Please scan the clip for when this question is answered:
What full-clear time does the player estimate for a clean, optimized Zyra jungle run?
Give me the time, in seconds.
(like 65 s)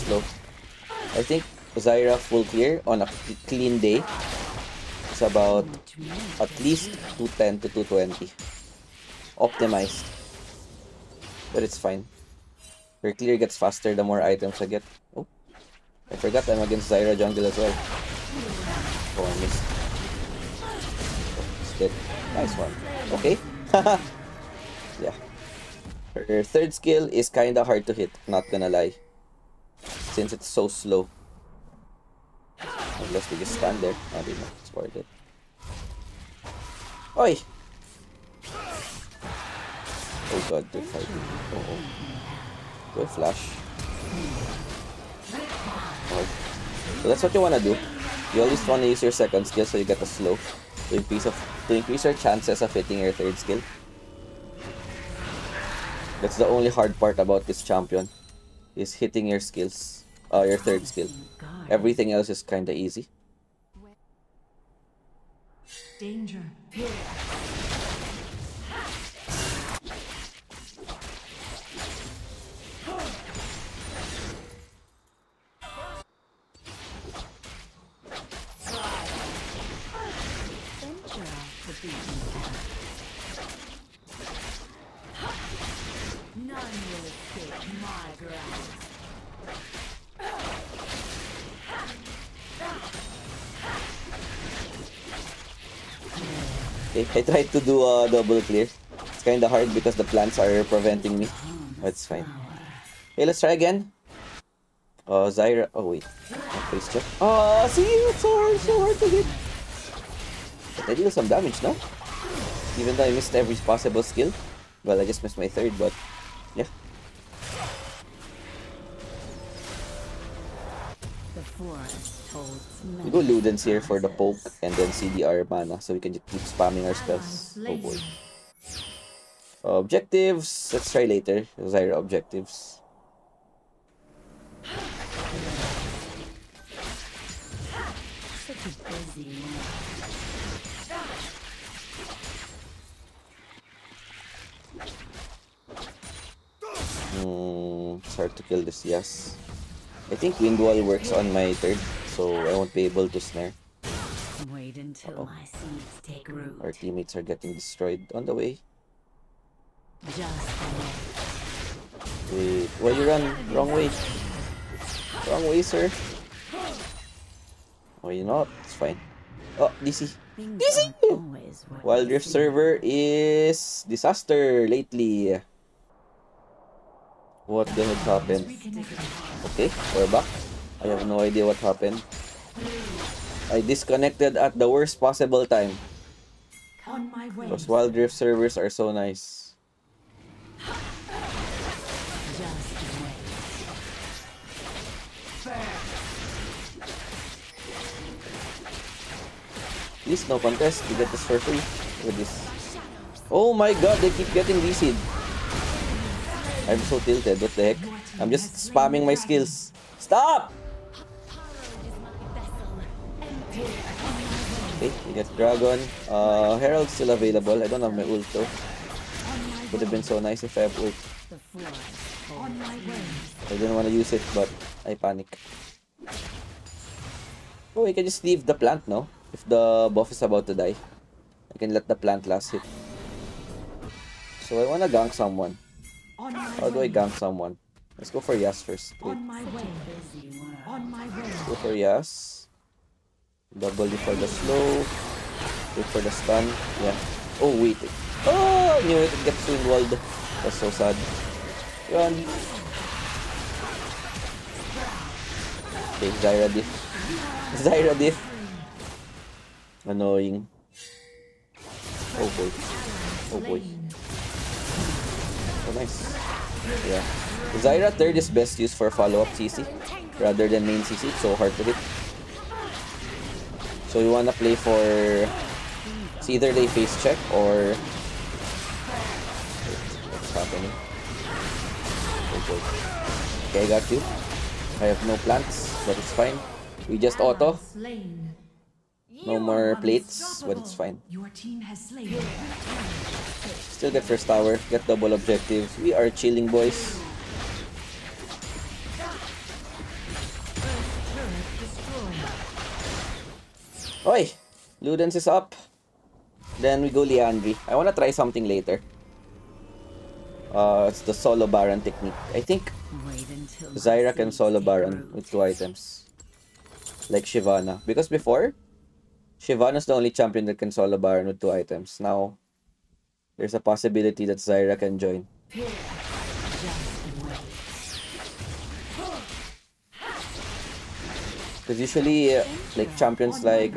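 7 s.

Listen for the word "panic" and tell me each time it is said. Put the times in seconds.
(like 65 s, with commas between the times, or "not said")
224 s.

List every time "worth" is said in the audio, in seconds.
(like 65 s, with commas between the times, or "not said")
34 s.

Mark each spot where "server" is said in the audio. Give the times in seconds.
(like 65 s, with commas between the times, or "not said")
172 s, 188 s.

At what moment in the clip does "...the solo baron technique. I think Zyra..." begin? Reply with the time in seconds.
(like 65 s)
311 s.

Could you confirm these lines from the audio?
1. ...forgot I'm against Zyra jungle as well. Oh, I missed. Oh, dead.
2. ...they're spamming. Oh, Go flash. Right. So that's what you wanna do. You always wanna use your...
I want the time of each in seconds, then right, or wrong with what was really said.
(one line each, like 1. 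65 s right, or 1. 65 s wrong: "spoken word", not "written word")
1. 16 s right
2. 40 s wrong: "fighting", not "spamming".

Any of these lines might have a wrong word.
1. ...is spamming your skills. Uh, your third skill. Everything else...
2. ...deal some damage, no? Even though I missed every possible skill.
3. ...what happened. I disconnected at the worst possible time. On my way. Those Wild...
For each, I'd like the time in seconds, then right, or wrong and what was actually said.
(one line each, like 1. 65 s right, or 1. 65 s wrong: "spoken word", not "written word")
1. 58 s wrong: "hitting", not "spamming"
2. 110 s right
3. 181 s right.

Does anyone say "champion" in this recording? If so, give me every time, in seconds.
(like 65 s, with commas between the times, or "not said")
57 s, 320 s, 332 s.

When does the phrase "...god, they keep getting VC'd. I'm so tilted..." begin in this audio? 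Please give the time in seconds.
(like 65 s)
203 s.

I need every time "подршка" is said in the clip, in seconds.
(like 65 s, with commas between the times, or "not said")
not said.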